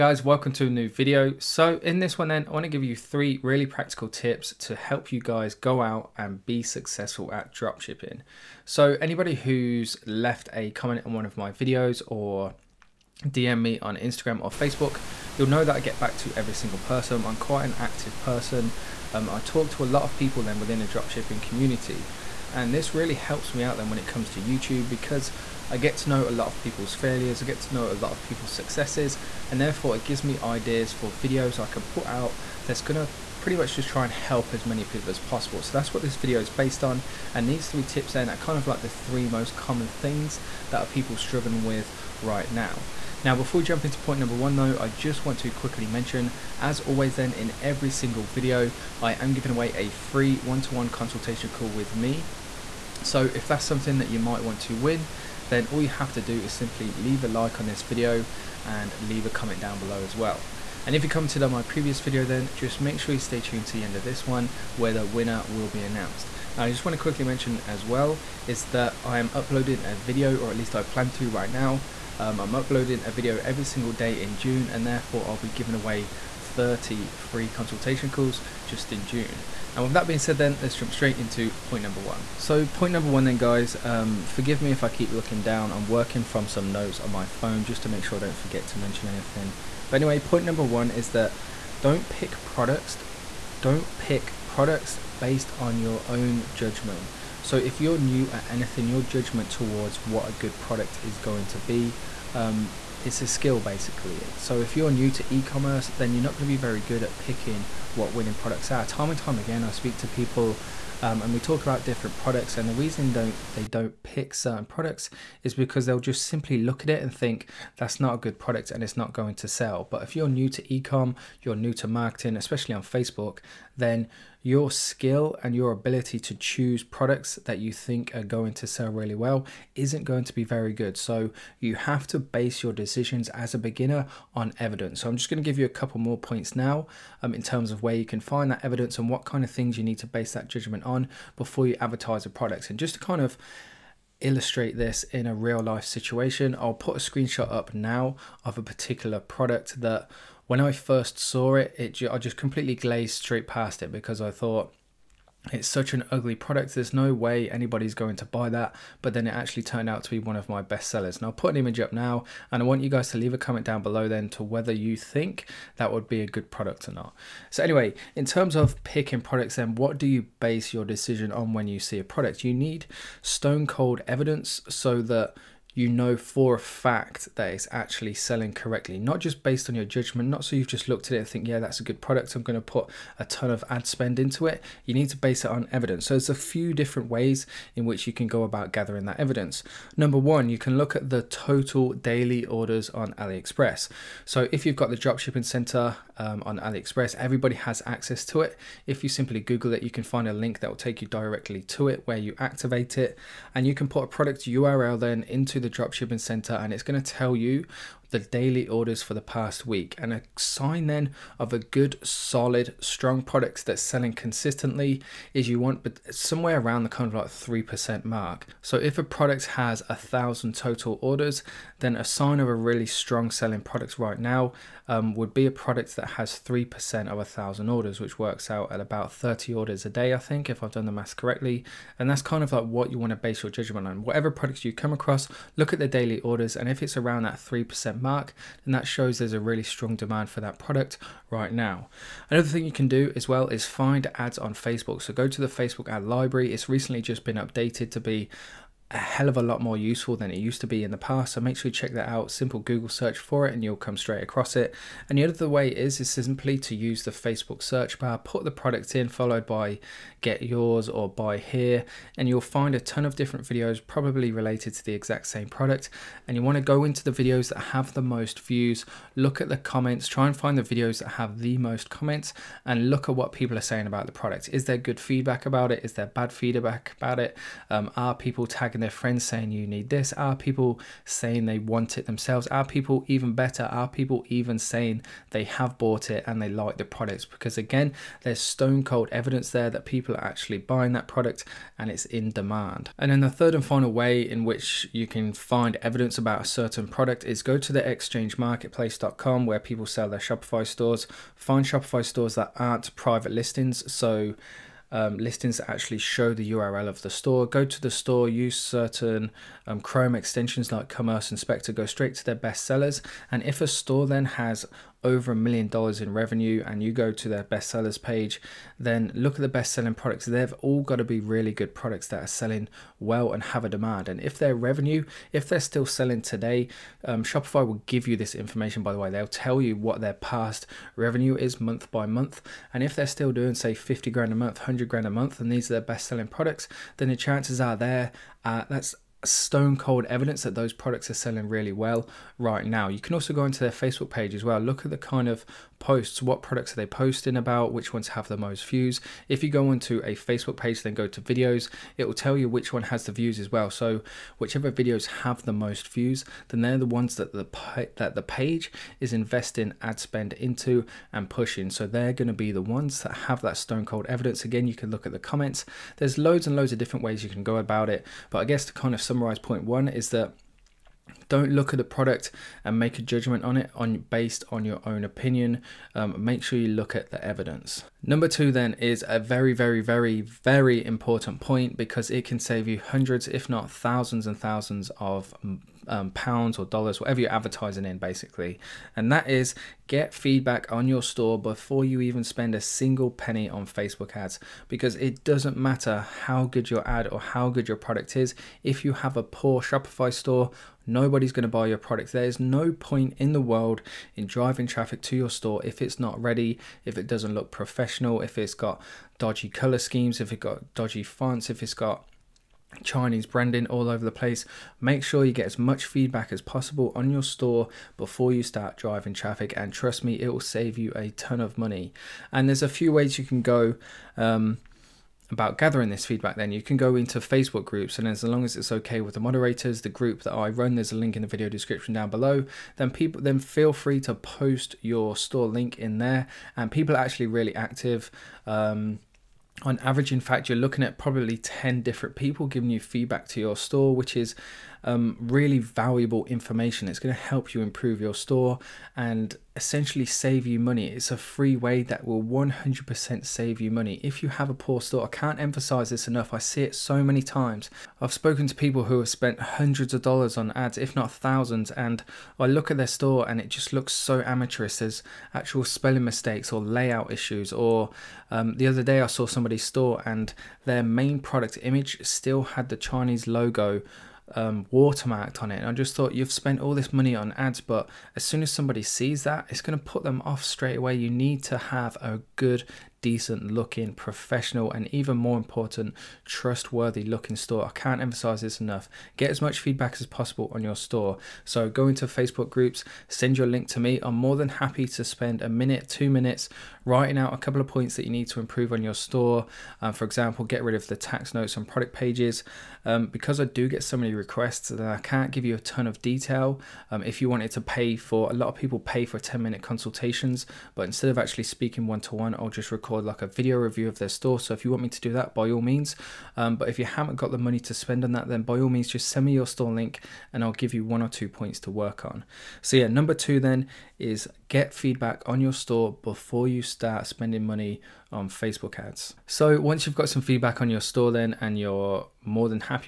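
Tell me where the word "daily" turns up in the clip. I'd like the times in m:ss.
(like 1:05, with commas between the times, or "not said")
3:11, 3:28, 3:55.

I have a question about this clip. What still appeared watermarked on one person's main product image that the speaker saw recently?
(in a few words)
Chinese logo.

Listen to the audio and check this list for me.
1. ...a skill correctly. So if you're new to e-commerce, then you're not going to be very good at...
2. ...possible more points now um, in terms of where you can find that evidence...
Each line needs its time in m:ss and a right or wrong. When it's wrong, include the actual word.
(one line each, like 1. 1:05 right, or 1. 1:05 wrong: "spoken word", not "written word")
1. 1:43 wrong: "basically", not "correctly"
2. 2:15 wrong: "couple", not "possible".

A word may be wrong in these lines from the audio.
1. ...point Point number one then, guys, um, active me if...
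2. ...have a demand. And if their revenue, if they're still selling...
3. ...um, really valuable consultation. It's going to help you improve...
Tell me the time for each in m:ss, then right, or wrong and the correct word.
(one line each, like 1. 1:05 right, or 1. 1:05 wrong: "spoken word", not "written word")
1. 1:22 wrong: "forgive", not "active"
2. 5:23 right
3. 7:24 wrong: "information", not "consultation".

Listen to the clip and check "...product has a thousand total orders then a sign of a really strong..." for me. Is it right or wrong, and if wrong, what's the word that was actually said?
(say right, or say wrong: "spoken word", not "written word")
right.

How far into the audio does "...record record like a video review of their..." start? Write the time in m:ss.
8:32.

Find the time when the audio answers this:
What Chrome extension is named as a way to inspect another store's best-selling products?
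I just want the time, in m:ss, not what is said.
5:10.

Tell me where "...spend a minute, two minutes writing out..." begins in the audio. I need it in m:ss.
8:15.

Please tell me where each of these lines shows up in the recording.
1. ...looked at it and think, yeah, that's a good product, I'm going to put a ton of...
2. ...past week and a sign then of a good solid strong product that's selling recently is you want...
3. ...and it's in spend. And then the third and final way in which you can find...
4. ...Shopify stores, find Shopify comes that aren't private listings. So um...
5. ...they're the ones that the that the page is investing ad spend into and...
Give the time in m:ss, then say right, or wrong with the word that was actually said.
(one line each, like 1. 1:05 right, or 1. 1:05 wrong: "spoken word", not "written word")
1. 3:00 right
2. 3:29 wrong: "consistently", not "recently"
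3. 4:51 wrong: "demand", not "spend"
4. 5:00 wrong: "stores", not "comes"
5. 5:56 right.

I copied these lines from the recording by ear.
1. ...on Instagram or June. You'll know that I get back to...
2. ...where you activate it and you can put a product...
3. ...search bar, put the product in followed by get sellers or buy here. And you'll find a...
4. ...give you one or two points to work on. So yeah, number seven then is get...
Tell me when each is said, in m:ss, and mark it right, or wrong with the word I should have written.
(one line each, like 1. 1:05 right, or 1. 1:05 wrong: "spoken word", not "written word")
1. 0:13 wrong: "Facebook", not "June"
2. 3:22 right
3. 4:17 wrong: "yours", not "sellers"
4. 8:40 wrong: "two", not "seven".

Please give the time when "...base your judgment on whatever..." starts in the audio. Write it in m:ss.
3:53.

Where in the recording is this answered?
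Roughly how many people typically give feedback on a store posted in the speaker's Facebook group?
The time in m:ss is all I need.
7:21.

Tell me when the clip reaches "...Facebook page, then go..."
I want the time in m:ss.
5:50.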